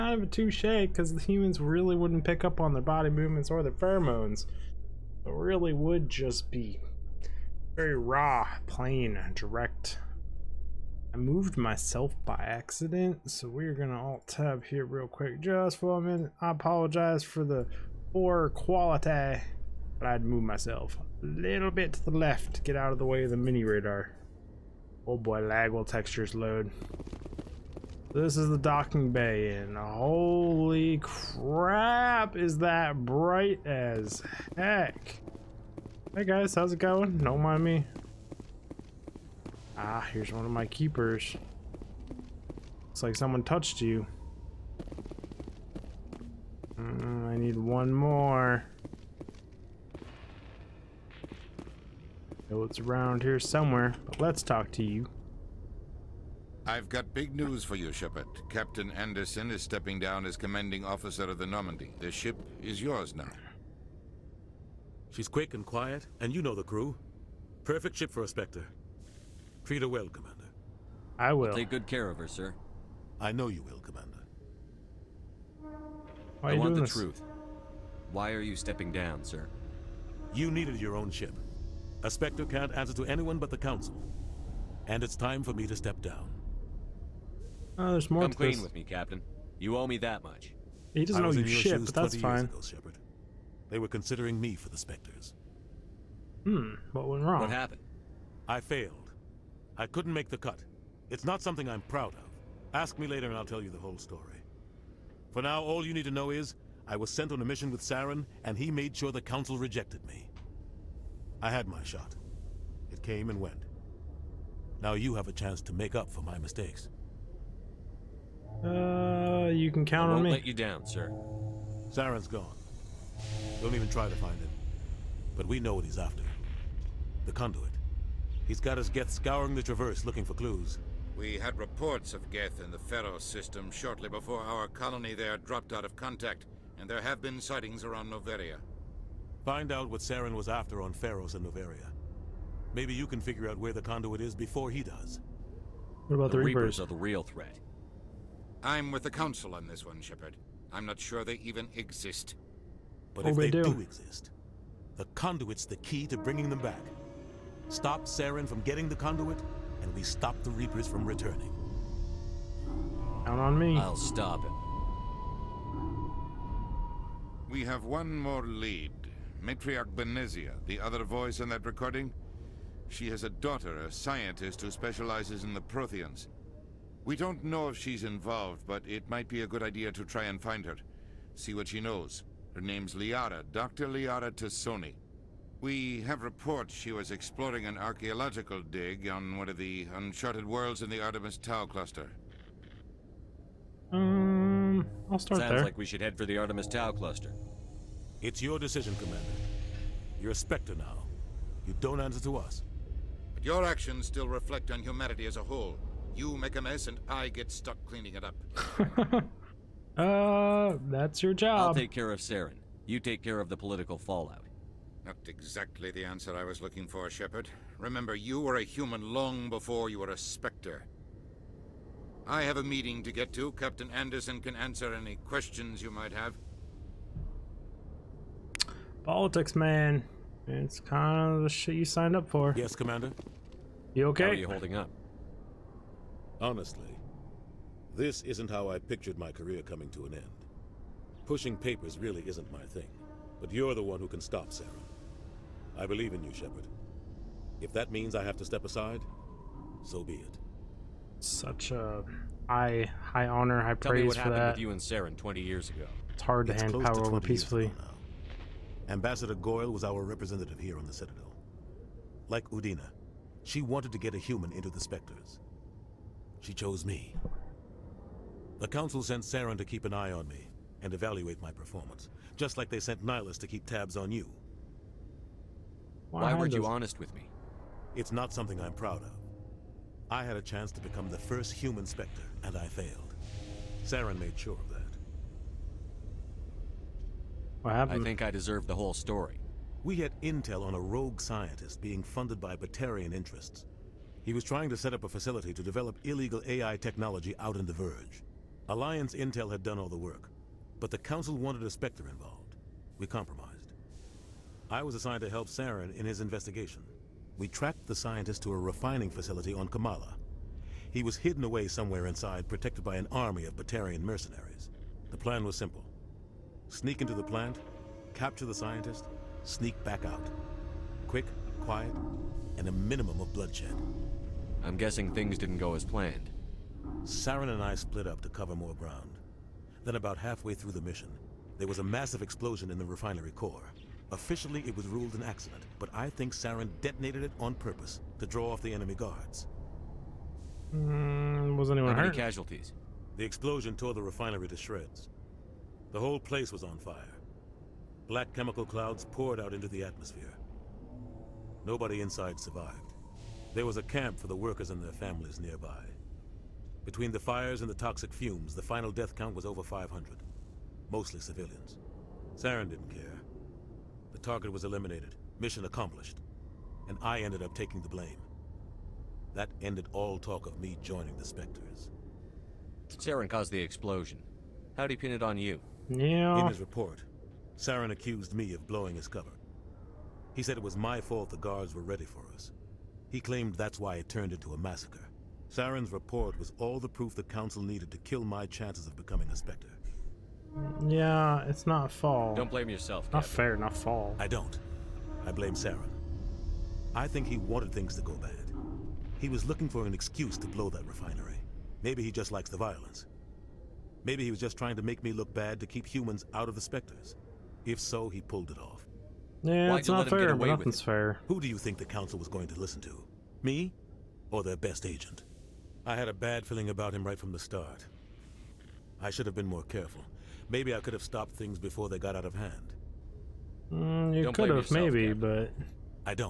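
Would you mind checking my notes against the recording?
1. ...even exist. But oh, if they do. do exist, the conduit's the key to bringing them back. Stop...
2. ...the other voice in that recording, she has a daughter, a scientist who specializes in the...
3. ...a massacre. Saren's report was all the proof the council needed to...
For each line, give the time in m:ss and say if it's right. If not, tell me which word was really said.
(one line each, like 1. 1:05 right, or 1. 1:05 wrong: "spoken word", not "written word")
1. 2:31 right
2. 2:50 right
3. 6:24 right.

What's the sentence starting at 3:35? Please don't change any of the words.
Not exactly the answer I was looking for, Shepard.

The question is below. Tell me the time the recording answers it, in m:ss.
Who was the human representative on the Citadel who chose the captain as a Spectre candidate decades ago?
4:18.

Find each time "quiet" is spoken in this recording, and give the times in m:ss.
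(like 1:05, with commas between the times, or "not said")
1:05, 5:21.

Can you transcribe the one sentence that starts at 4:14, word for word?
with you and Saren 20 years ago.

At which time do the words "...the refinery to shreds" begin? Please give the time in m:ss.
5:43.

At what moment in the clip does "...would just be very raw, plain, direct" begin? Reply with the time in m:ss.
0:05.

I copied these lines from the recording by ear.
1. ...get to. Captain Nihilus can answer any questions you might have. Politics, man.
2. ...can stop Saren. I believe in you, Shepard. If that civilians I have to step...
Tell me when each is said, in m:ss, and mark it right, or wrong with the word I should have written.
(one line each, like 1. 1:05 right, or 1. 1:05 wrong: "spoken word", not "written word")
1. 3:43 wrong: "Anderson", not "Nihilus"
2. 4:04 wrong: "means", not "civilians".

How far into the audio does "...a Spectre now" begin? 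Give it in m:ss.
3:20.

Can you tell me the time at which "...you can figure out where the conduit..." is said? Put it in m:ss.
2:22.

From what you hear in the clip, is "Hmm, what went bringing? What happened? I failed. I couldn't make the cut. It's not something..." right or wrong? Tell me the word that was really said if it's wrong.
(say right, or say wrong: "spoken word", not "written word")
wrong: "wrong", not "bringing".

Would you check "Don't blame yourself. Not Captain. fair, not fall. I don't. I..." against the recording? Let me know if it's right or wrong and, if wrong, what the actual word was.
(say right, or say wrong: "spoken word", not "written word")
right.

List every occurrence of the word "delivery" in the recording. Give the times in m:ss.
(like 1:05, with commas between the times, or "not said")
not said.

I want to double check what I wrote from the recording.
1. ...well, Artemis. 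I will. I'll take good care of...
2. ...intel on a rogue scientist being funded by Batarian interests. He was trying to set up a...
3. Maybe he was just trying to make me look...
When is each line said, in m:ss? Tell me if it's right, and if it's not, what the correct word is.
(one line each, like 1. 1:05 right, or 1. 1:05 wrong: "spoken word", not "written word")
1. 1:09 wrong: "Commander", not "Artemis"
2. 4:50 right
3. 6:44 right.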